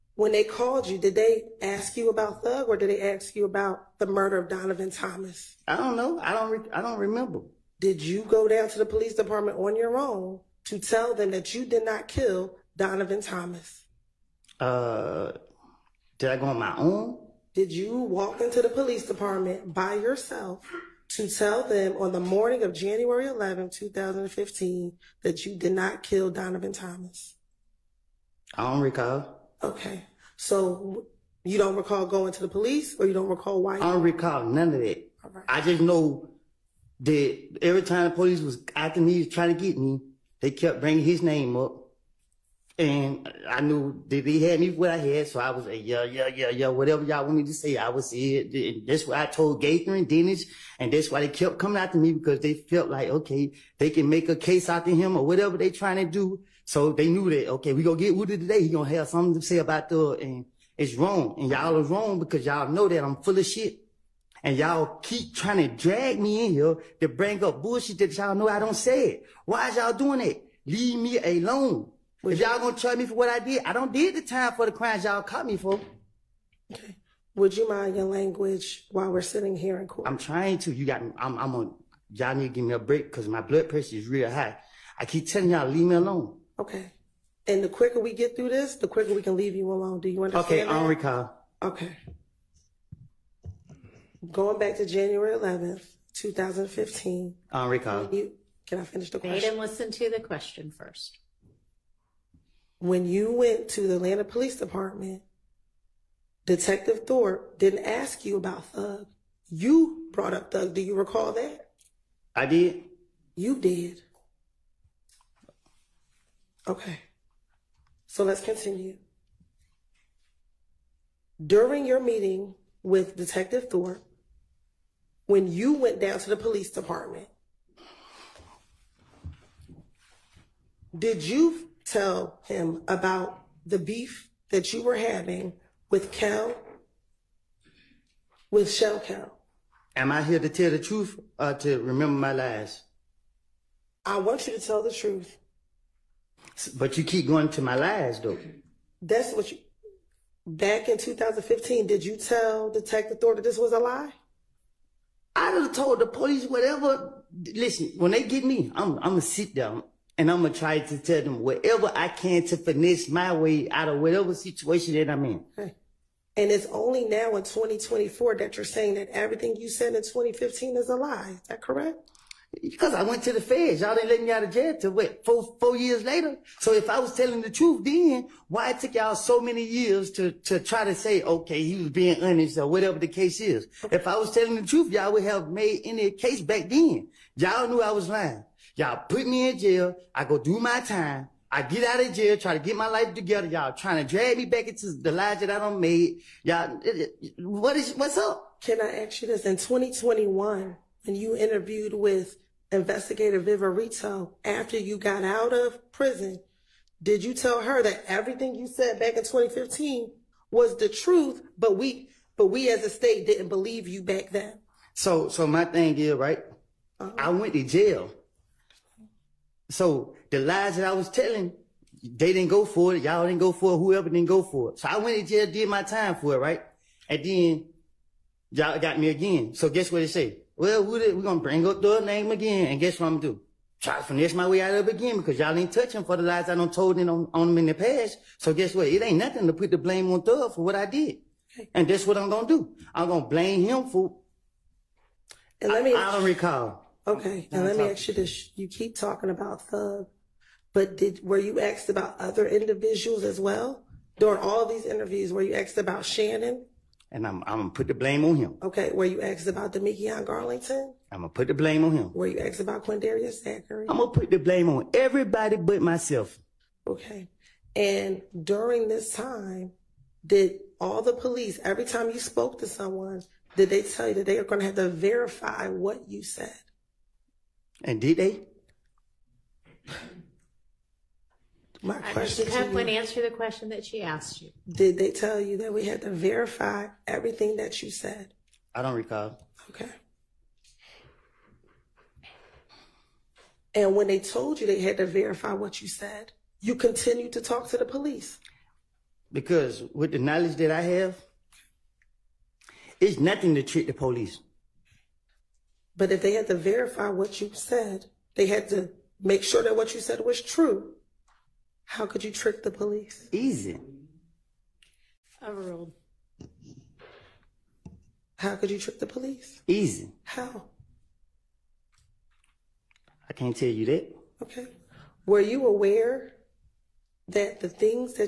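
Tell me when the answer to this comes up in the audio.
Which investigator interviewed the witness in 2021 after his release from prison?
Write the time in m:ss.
3:23.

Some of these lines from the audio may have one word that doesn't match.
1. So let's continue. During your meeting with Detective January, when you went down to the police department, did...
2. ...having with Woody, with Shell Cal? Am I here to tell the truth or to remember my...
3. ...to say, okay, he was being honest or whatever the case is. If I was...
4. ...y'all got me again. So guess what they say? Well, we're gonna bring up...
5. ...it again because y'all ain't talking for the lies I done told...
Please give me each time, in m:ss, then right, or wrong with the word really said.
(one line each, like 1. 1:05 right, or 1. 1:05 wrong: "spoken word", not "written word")
1. 1:58 wrong: "Thorpe", not "January"
2. 2:14 wrong: "Cal", not "Woody"
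3. 3:00 right
4. 3:48 right
5. 3:54 wrong: "touching", not "talking".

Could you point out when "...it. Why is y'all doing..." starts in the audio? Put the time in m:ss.
1:09.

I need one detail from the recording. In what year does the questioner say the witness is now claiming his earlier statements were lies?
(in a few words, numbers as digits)
2024.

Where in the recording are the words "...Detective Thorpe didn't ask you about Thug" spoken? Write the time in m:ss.
1:46.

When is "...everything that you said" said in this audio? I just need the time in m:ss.
4:47.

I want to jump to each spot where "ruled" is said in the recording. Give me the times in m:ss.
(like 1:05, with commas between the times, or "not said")
5:15.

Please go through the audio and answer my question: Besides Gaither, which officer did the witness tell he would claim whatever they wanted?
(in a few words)
Dennis.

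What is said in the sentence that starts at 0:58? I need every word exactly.
He gonna have something to say about the, and it's wrong.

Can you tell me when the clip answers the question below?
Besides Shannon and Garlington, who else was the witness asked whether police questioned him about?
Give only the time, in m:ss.
4:22.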